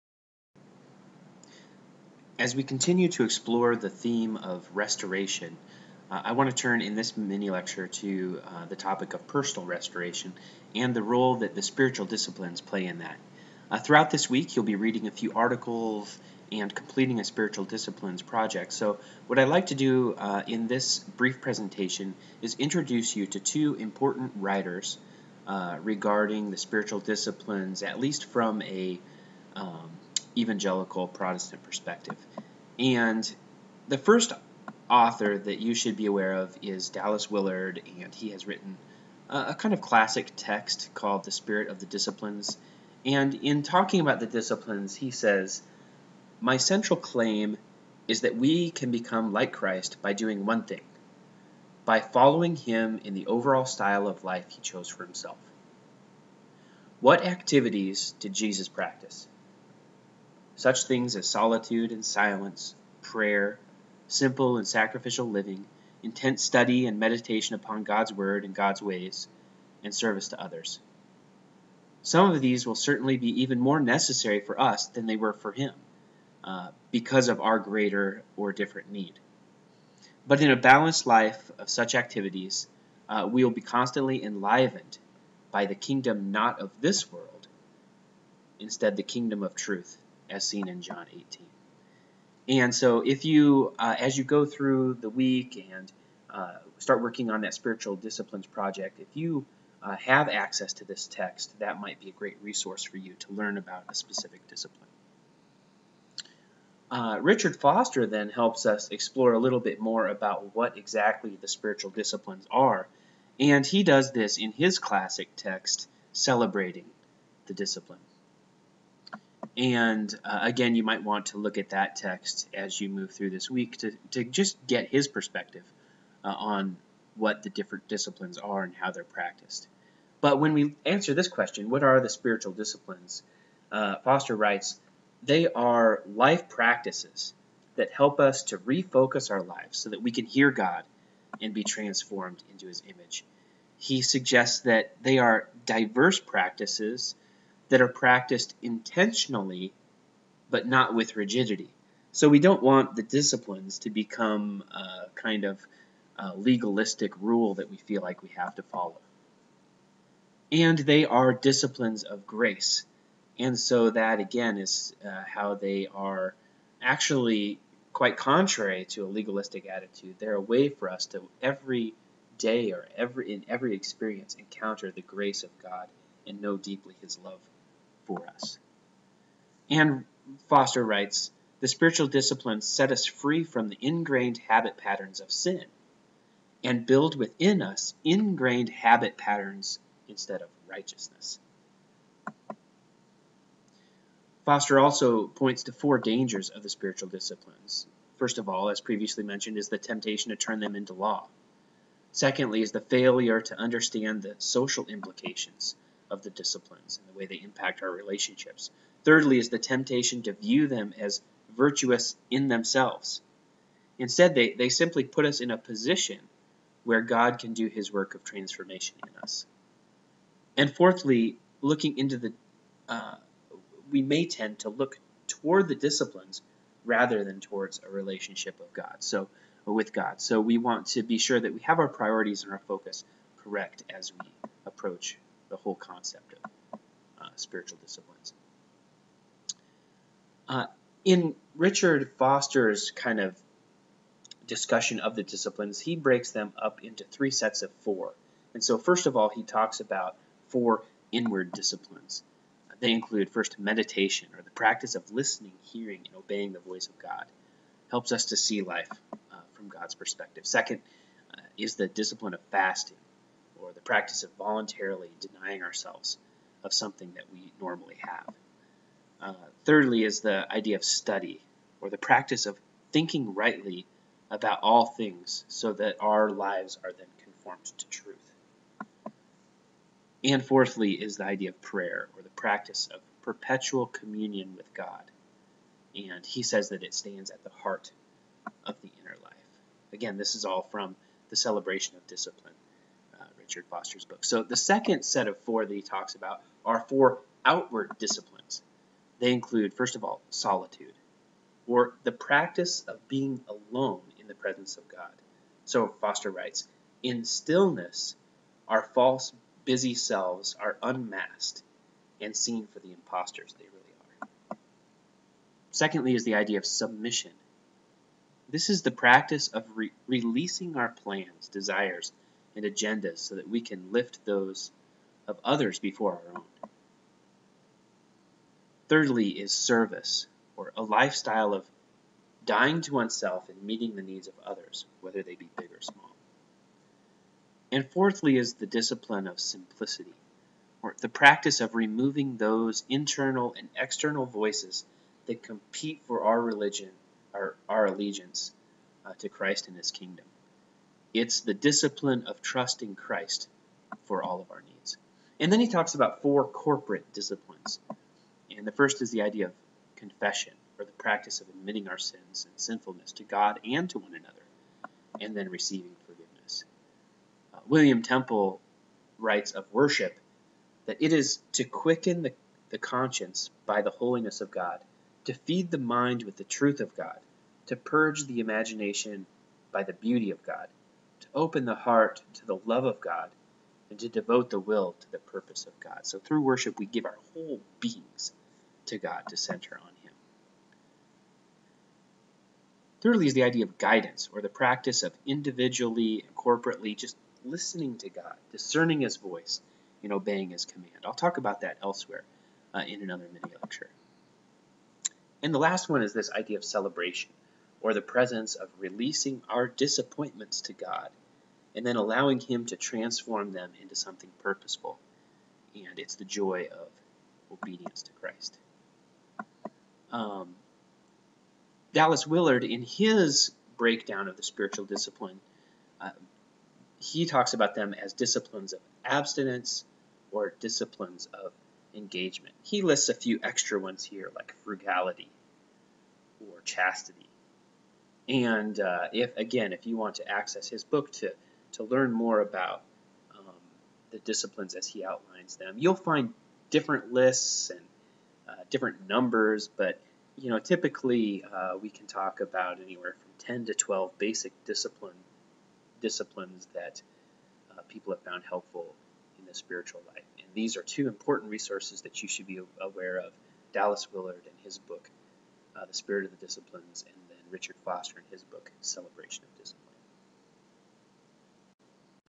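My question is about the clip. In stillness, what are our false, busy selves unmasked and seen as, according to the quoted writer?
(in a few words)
Impostors.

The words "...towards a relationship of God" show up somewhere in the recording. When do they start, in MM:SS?
03:47.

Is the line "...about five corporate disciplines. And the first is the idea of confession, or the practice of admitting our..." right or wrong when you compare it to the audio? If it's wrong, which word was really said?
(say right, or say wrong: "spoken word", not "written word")
wrong: "four", not "five".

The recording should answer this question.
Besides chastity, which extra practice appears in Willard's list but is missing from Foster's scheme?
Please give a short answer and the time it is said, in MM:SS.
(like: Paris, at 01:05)
Frugality, at 07:14.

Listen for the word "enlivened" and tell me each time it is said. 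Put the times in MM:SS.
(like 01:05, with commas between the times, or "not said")
01:24.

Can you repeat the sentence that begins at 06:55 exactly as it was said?
And it's the joy of obedience to Christ.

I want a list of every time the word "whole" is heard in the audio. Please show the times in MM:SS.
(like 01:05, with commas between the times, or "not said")
03:55, 06:27.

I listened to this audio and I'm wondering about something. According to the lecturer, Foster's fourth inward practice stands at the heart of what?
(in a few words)
The inner life.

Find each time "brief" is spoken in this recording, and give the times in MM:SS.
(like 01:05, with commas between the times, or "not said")
00:20.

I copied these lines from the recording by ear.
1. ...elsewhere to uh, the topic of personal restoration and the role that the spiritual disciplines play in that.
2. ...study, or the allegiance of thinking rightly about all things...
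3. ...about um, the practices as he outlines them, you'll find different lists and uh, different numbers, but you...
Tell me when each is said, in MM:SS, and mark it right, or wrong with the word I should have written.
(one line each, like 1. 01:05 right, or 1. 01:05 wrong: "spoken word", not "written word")
1. 00:07 wrong: "lecture", not "elsewhere"
2. 04:30 wrong: "practice", not "allegiance"
3. 07:22 wrong: "disciplines", not "practices".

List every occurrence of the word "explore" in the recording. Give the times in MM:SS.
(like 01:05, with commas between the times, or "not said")
00:03, 01:48.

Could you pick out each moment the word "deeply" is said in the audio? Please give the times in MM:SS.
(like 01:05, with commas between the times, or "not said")
02:56.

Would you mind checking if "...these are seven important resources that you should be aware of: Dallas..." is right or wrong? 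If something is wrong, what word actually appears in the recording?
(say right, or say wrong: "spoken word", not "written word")
wrong: "two", not "seven".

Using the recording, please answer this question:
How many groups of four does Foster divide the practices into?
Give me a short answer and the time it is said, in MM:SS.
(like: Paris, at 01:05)
3, at 04:07.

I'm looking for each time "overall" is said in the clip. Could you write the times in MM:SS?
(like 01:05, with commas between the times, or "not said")
00:53.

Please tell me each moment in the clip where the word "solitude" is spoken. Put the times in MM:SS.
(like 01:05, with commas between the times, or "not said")
01:01, 05:00.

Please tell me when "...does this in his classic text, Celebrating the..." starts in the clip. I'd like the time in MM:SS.
01:53.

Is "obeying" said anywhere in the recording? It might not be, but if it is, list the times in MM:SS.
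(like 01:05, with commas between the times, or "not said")
04:16, 06:40.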